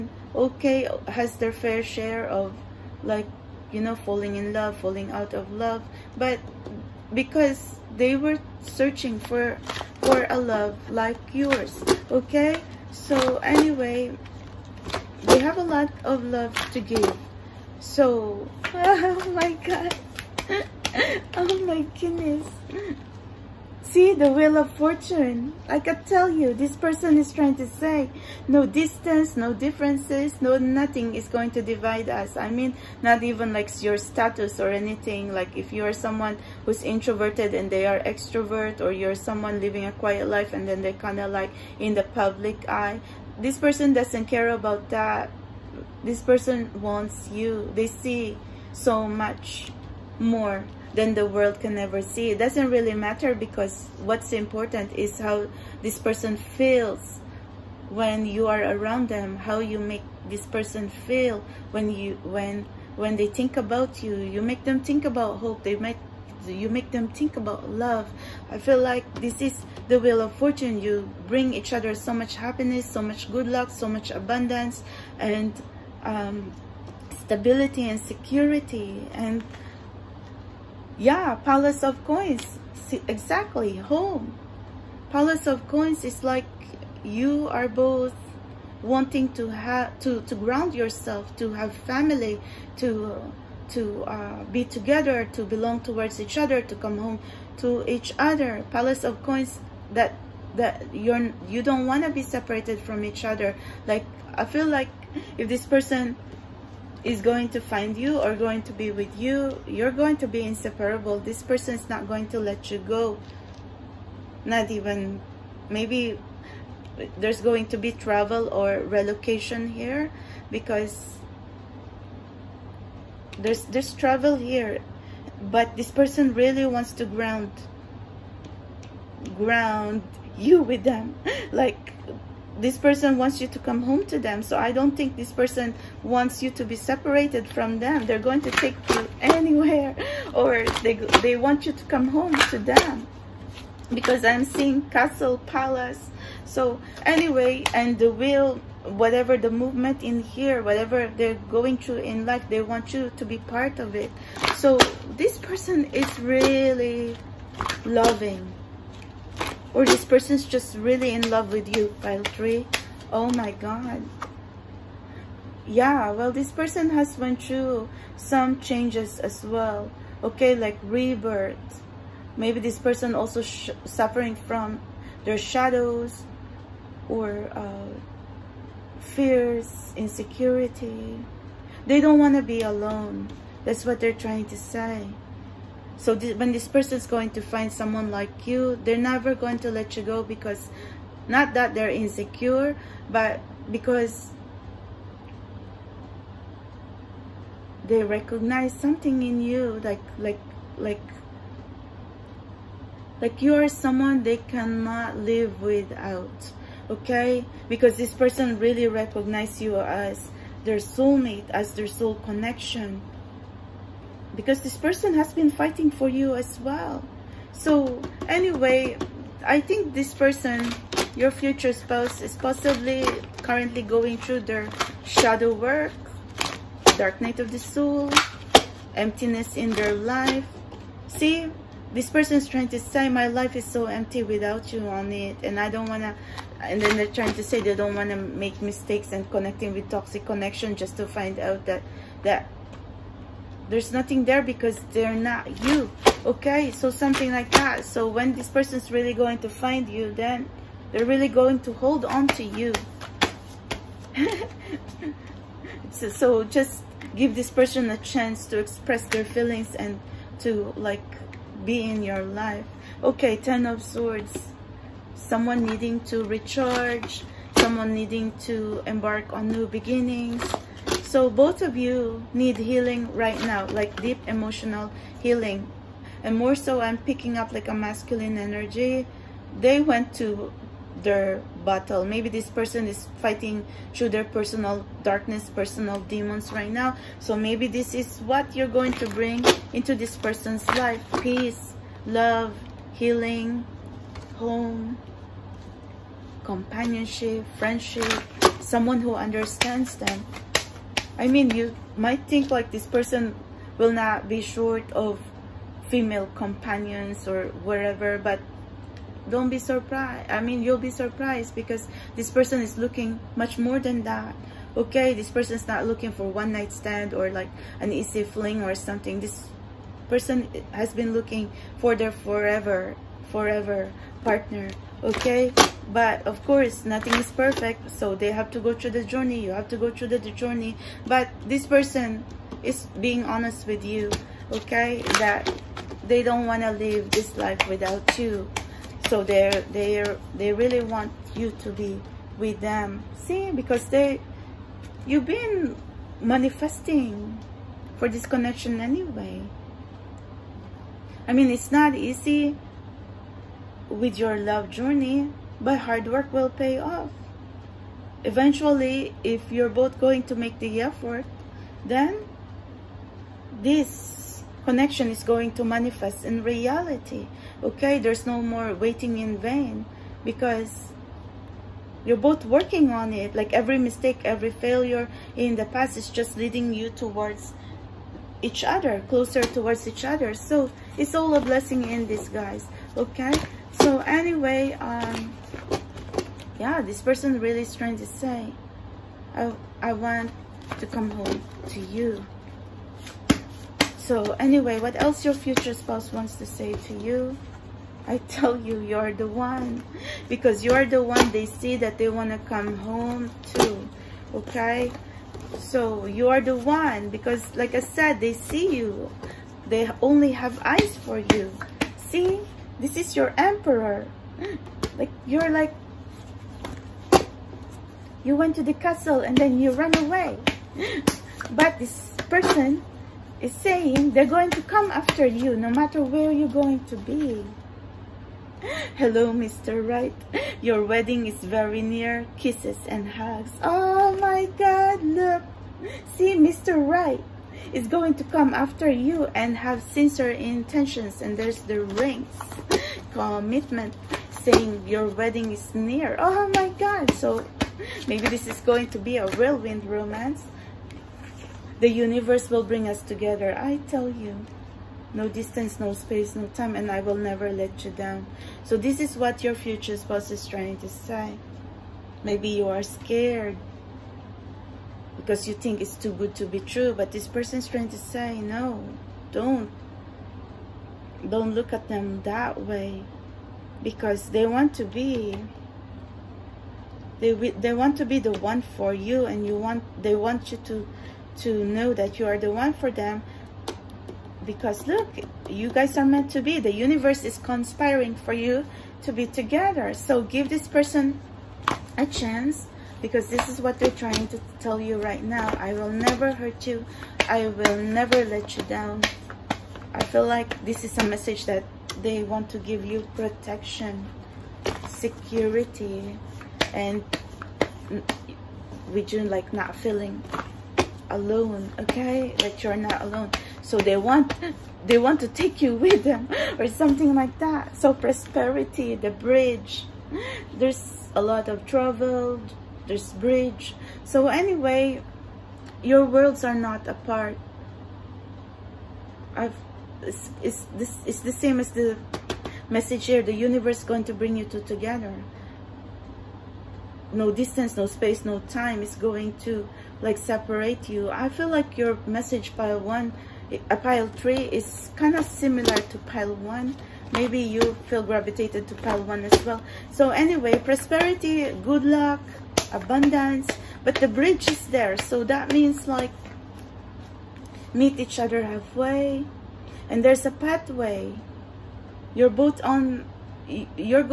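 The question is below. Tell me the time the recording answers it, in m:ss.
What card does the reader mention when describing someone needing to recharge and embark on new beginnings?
4:23.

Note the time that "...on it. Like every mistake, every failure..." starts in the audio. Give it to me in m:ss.
6:12.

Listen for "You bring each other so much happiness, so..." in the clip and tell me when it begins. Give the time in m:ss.
1:10.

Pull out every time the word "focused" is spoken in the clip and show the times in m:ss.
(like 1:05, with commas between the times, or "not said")
not said.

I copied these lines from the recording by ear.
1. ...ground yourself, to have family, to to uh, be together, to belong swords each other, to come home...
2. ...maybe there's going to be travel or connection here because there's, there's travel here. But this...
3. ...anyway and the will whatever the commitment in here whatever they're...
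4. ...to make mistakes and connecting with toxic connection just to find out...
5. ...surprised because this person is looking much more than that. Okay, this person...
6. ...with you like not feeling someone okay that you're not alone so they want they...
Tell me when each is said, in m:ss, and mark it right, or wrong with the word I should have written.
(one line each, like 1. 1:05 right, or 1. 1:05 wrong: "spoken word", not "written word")
1. 1:30 wrong: "towards", not "swords"
2. 1:55 wrong: "relocation", not "connection"
3. 2:27 wrong: "movement", not "commitment"
4. 3:58 right
5. 5:10 right
6. 8:28 wrong: "alone", not "someone".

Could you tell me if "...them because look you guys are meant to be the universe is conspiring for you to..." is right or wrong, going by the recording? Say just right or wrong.
right.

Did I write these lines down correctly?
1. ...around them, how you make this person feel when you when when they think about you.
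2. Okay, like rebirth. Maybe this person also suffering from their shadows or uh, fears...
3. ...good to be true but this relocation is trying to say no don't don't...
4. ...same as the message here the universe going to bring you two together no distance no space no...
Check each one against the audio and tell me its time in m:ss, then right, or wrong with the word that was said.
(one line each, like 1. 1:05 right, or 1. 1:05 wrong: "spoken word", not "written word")
1. 0:58 right
2. 2:50 right
3. 7:46 wrong: "person", not "relocation"
4. 8:51 right.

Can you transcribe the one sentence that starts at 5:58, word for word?
Eventually, if you're both going to make the effort, then this connection is going to manifest in reality.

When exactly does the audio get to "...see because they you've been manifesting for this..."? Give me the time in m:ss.
5:43.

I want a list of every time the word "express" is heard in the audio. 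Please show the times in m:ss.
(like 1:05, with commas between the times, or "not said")
4:18.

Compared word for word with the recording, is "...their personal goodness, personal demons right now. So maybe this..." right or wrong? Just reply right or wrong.
wrong.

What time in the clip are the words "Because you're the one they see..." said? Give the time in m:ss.
6:40.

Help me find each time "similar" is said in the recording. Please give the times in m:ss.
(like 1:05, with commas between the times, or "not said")
9:05.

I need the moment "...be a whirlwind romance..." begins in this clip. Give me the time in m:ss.
7:28.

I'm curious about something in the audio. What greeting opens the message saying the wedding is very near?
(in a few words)
Hello, Mr. Right.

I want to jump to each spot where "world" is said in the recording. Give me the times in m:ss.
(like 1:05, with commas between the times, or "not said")
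0:51, 8:46.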